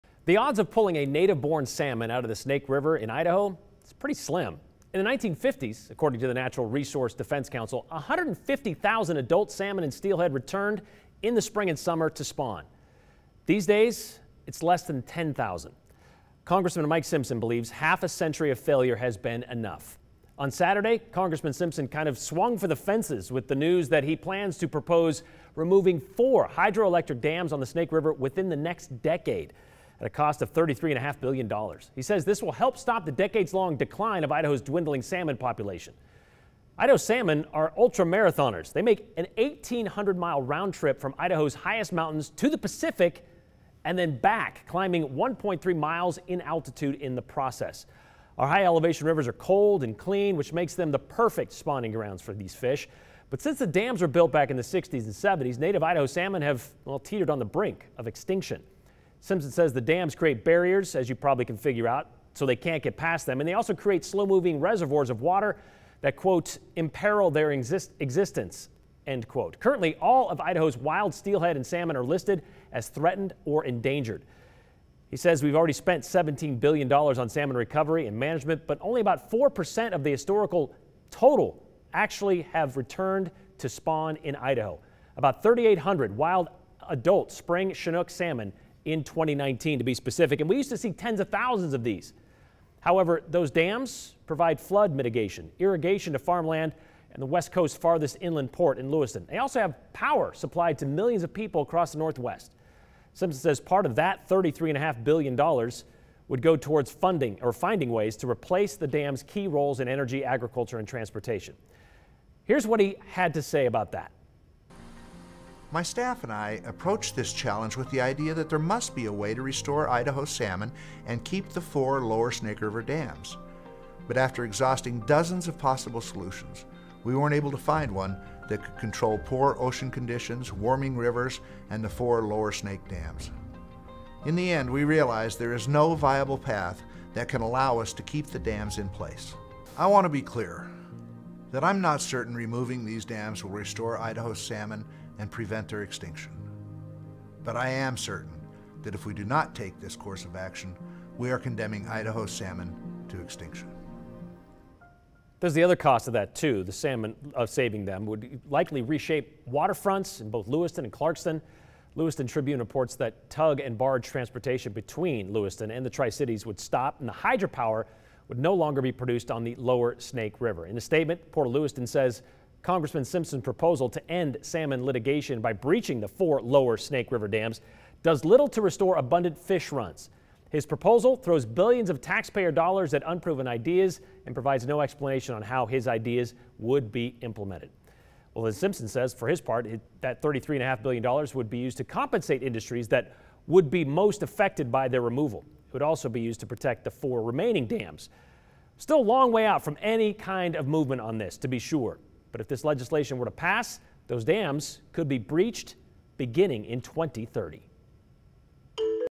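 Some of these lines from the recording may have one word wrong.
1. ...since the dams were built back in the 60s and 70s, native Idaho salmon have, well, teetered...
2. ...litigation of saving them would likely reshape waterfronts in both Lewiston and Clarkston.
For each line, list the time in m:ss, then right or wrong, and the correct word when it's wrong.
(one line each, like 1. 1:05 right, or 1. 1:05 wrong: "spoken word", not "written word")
1. 0:53 right
2. 2:36 wrong: "salmon", not "litigation".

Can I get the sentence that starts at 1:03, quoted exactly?
And they also create slow moving reservoirs of water that, quote, imperil their exist existence, end quote.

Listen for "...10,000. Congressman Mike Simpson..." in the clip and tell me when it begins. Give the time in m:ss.
0:15.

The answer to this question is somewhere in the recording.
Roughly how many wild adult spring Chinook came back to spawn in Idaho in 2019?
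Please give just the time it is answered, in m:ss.
1:25.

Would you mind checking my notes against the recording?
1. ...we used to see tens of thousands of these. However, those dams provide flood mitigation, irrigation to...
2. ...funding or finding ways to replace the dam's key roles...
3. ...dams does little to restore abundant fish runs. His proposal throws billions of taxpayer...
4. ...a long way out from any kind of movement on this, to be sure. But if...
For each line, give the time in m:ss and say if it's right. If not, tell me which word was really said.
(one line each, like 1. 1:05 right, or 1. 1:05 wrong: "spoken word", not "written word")
1. 1:30 right
2. 1:46 right
3. 2:57 right
4. 3:18 right.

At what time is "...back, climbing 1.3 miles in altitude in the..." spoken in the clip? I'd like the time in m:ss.
0:44.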